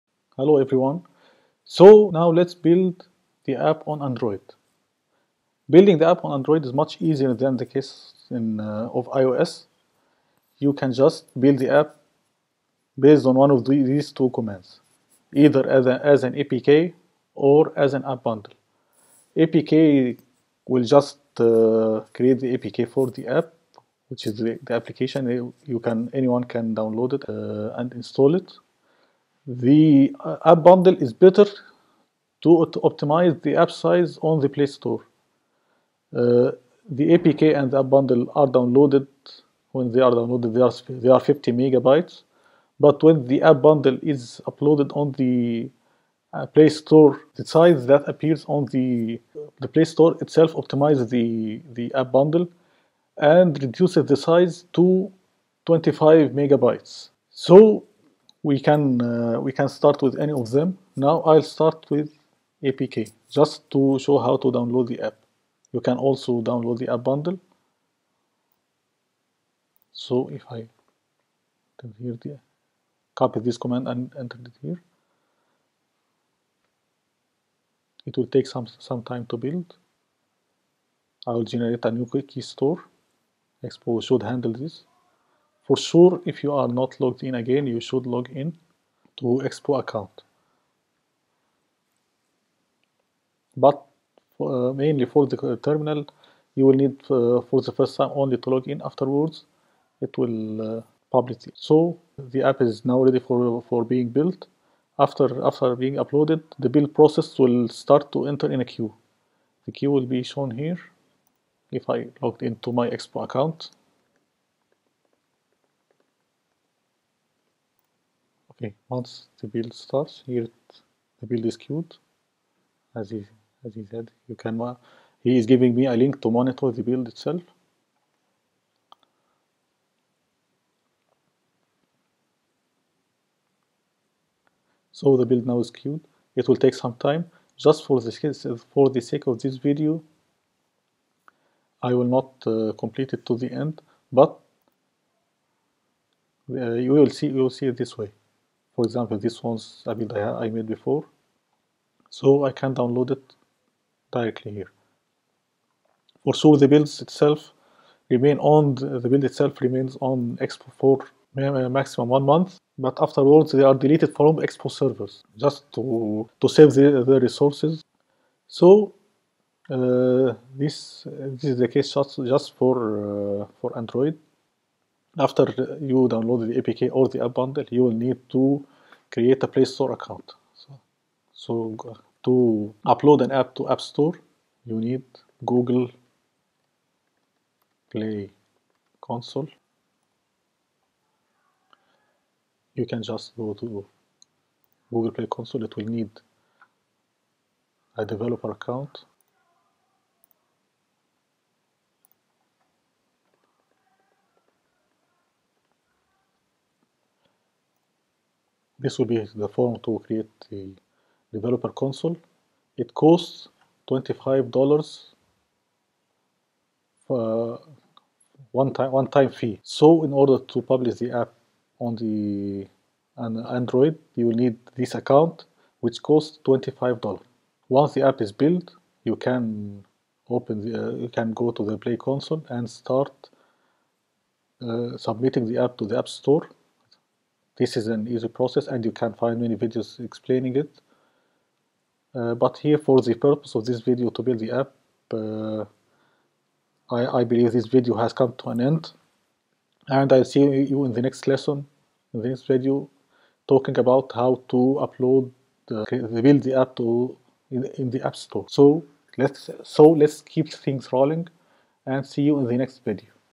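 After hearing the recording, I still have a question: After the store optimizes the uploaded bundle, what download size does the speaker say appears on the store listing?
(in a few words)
25 megabytes.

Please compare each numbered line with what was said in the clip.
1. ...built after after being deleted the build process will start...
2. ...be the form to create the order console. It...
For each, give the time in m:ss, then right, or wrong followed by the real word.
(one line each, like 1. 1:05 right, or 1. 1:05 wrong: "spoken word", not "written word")
1. 1:44 wrong: "uploaded", not "deleted"
2. 3:29 wrong: "developer", not "order".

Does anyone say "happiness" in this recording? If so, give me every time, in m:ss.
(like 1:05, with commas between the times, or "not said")
not said.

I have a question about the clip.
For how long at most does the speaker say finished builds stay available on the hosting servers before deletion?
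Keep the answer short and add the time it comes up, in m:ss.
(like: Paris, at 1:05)
one month, at 2:41.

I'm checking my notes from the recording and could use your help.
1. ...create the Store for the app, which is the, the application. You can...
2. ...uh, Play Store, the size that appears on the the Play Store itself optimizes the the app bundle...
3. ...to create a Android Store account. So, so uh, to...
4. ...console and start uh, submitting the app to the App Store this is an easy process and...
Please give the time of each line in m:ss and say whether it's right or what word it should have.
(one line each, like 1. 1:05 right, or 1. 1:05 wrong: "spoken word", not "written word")
1. 0:22 wrong: "APK", not "Store"
2. 0:46 right
3. 2:58 wrong: "Play", not "Android"
4. 3:51 right.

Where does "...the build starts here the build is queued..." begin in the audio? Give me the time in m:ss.
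1:59.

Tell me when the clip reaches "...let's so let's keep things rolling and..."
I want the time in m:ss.
4:19.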